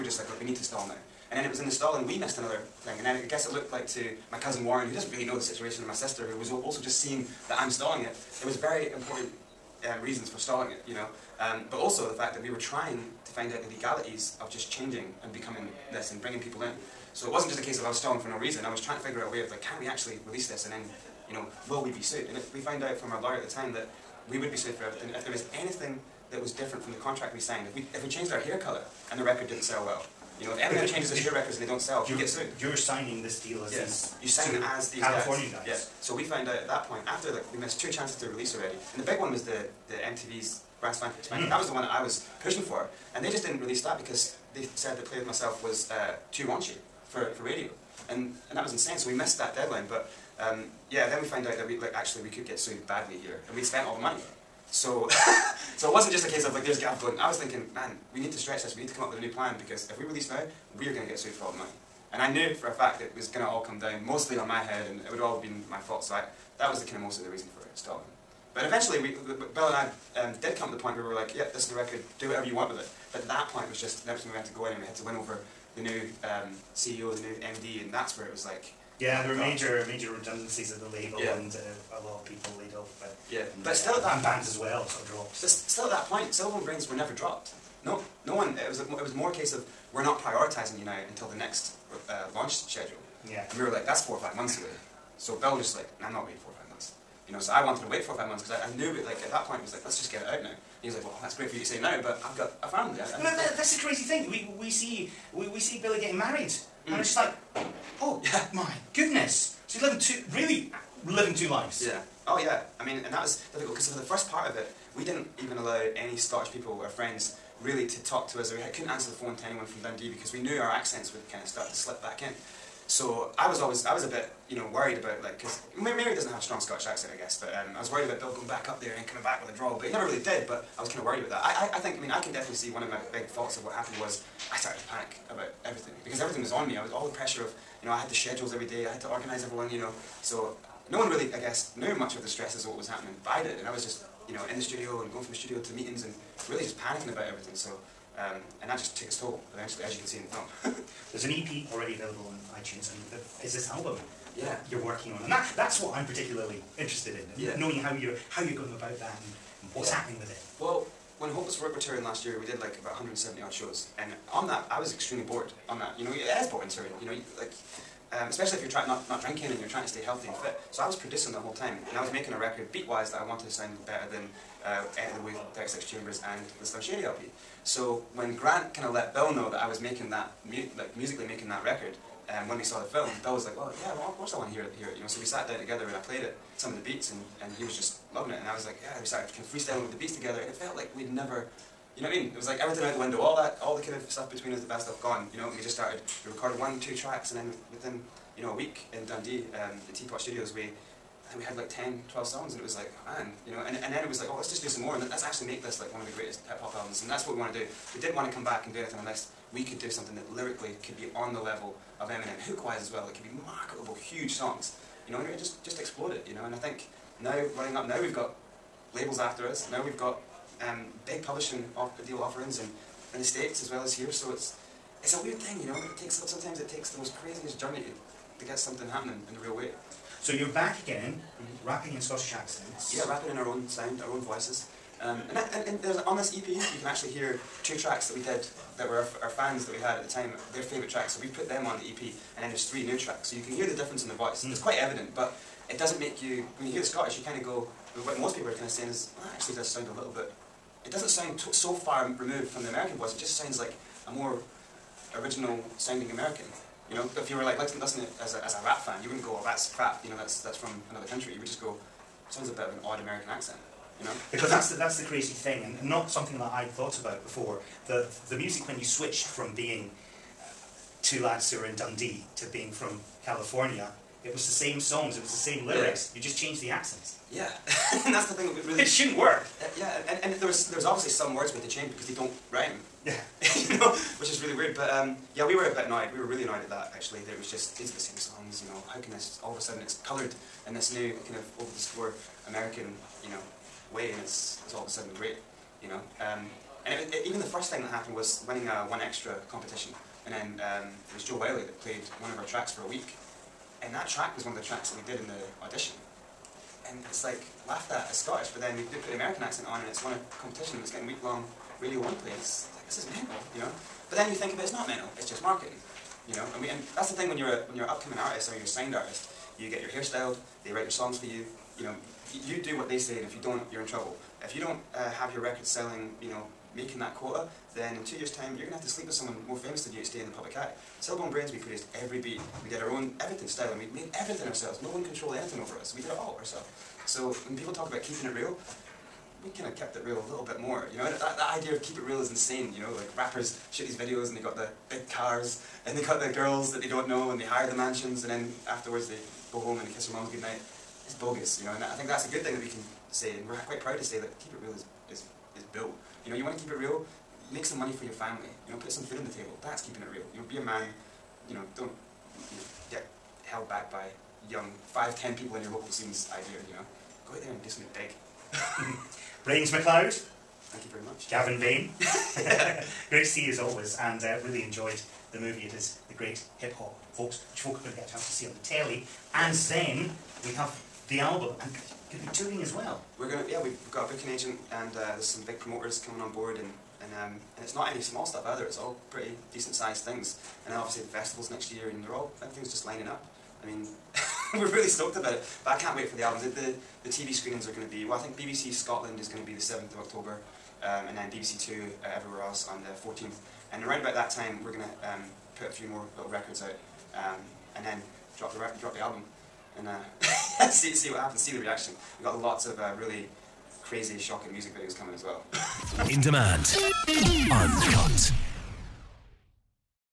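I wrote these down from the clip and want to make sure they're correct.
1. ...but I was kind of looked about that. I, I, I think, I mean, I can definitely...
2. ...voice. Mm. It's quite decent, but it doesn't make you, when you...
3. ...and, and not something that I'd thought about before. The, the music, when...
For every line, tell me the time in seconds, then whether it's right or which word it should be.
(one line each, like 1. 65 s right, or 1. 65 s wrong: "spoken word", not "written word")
1. 130 s wrong: "worried", not "looked"
2. 244 s wrong: "evident", not "decent"
3. 265 s right.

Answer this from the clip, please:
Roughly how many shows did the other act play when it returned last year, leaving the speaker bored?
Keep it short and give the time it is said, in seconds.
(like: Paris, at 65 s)
170, at 162 s.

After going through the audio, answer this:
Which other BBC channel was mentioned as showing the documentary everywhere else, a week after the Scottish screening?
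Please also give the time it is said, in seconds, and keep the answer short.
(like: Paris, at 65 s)
BBC Two, at 401 s.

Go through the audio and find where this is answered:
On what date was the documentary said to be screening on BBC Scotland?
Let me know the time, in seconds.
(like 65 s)
399 s.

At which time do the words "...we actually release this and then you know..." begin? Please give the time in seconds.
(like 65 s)
19 s.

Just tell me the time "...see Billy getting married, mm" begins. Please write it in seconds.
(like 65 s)
105 s.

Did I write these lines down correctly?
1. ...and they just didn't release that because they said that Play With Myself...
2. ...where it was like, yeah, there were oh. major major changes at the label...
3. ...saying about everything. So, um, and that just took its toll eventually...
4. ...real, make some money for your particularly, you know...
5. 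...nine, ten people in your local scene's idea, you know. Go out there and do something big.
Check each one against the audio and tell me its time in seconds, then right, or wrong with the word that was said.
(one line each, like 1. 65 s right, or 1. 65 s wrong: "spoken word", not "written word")
1. 43 s right
2. 78 s wrong: "redundancies", not "changes"
3. 146 s wrong: "panicking", not "saying"
4. 356 s wrong: "family", not "particularly"
5. 364 s wrong: "five", not "nine".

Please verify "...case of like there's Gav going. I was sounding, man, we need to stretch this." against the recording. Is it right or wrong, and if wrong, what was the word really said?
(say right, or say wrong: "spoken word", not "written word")
wrong: "thinking", not "sounding".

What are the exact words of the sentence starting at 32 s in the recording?
You're signing this deal as yes.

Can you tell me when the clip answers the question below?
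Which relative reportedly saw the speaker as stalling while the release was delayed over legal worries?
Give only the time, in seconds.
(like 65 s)
4 s.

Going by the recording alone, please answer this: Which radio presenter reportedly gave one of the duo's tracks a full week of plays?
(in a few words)
Jo Whiley.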